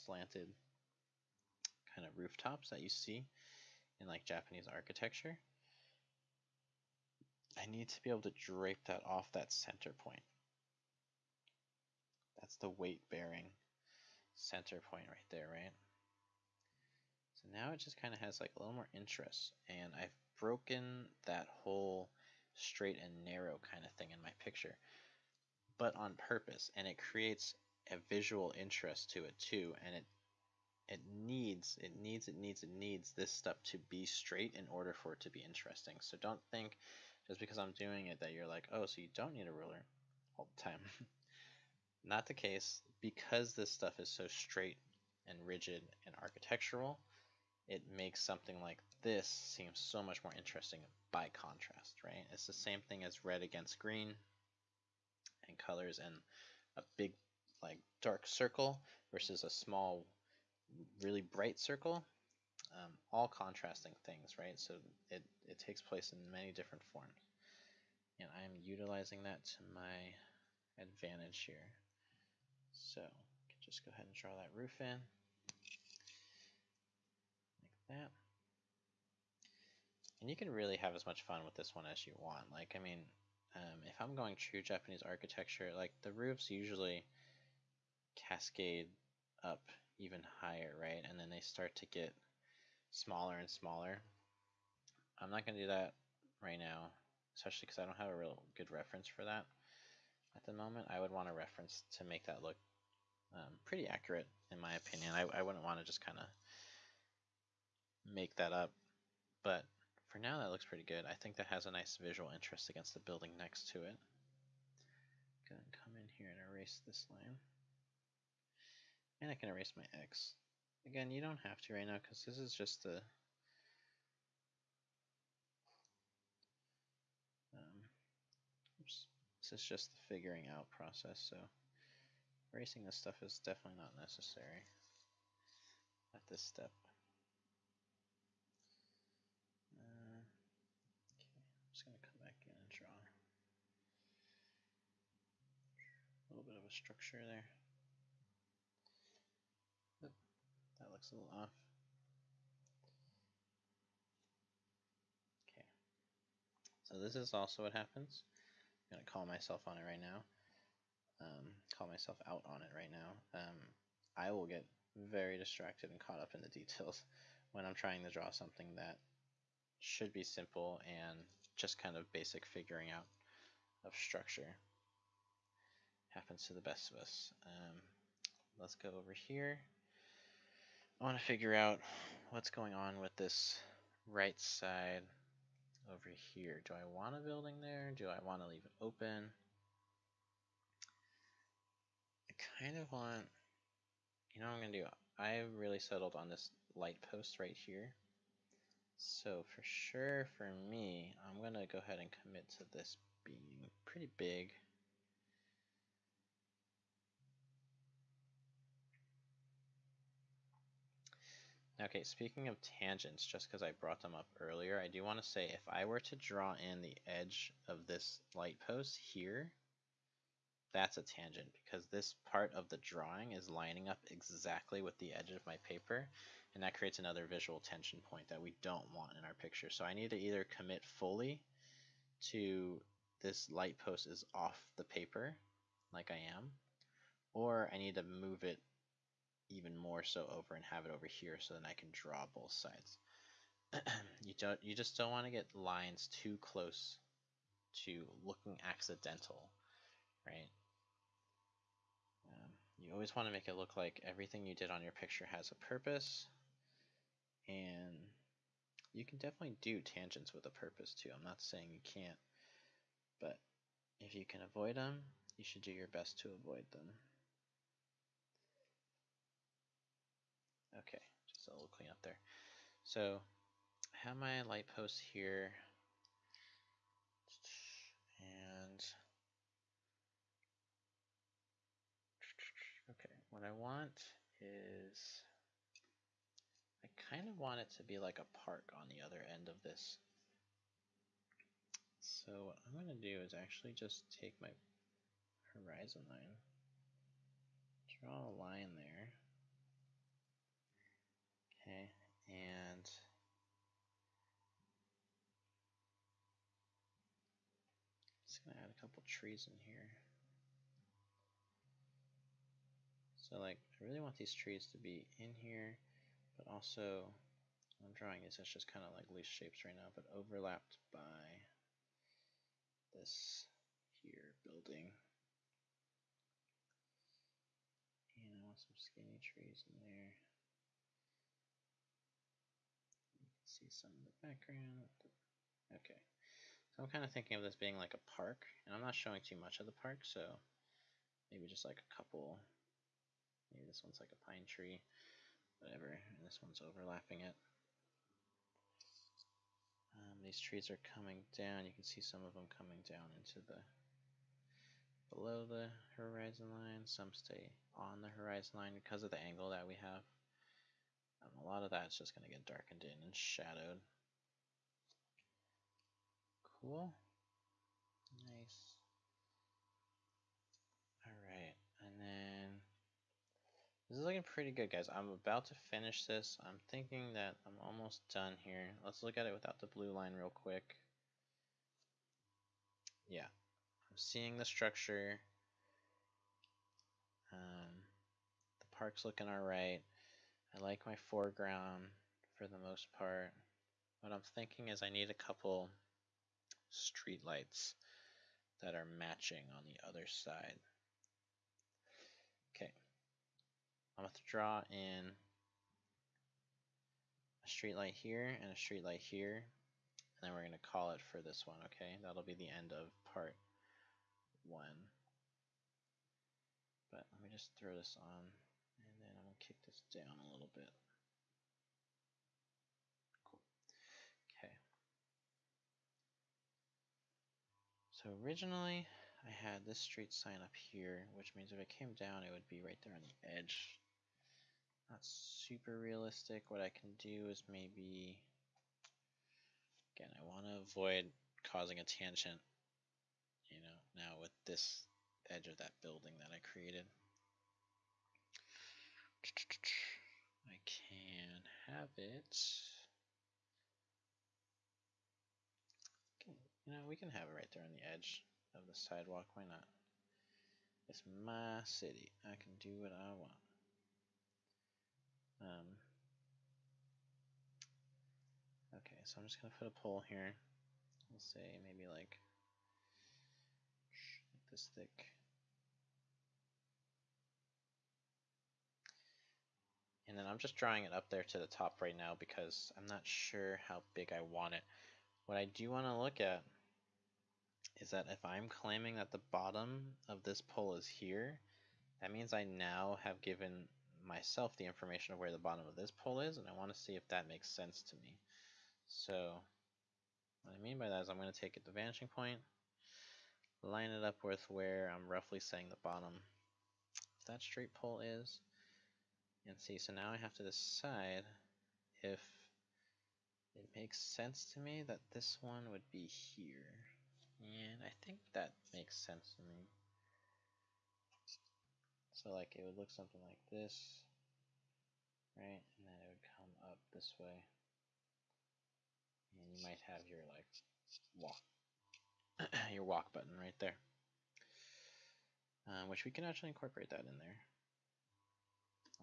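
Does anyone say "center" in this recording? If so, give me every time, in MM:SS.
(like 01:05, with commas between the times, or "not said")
00:09, 00:14.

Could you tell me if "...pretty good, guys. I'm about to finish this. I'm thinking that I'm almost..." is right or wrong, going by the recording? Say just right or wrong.
right.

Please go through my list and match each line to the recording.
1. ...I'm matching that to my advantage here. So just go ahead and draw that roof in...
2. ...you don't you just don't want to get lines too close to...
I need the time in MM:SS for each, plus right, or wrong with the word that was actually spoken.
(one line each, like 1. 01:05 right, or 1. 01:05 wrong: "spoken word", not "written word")
1. 01:08 wrong: "utilizing", not "matching"
2. 04:04 right.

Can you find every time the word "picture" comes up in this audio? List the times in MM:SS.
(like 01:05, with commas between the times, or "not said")
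00:24, 03:49, 04:14.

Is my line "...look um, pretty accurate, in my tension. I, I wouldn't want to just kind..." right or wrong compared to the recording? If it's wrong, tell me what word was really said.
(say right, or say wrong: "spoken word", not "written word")
wrong: "opinion", not "tension".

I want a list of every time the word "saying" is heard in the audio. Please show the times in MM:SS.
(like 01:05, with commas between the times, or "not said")
04:21, 08:25.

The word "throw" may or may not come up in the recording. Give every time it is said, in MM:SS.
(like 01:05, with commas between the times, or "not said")
06:57.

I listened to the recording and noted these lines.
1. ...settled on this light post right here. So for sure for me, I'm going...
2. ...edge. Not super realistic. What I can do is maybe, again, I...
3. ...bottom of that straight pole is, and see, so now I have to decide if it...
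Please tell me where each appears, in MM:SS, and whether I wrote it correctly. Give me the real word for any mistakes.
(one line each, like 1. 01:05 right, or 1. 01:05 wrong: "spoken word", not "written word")
1. 03:15 right
2. 07:13 right
3. 08:25 right.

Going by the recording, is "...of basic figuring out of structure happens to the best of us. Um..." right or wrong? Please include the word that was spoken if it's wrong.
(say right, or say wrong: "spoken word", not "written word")
right.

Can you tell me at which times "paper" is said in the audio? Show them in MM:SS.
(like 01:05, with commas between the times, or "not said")
03:45, 03:54.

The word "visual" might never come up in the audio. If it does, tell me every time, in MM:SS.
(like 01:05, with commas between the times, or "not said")
00:28, 01:52, 03:47.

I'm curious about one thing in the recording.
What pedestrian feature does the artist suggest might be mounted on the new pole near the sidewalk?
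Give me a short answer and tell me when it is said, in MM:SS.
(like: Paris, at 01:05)
Walk button, at 08:52.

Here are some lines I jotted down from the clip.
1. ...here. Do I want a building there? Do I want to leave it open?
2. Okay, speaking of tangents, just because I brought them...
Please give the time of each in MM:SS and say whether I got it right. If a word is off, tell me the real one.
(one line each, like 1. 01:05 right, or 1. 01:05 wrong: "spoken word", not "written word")
1. 03:06 right
2. 03:31 right.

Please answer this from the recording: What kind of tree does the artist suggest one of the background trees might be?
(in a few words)
Pine tree.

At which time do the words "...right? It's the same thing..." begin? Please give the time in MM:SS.
00:52.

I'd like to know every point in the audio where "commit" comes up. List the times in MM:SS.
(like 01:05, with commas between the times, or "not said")
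03:22, 03:50.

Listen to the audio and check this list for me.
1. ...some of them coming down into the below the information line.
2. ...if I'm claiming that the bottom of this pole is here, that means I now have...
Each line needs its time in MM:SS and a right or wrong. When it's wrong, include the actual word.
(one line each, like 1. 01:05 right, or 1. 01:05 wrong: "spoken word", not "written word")
1. 05:51 wrong: "horizon", not "information"
2. 08:08 right.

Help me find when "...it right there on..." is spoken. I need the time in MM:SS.
07:37.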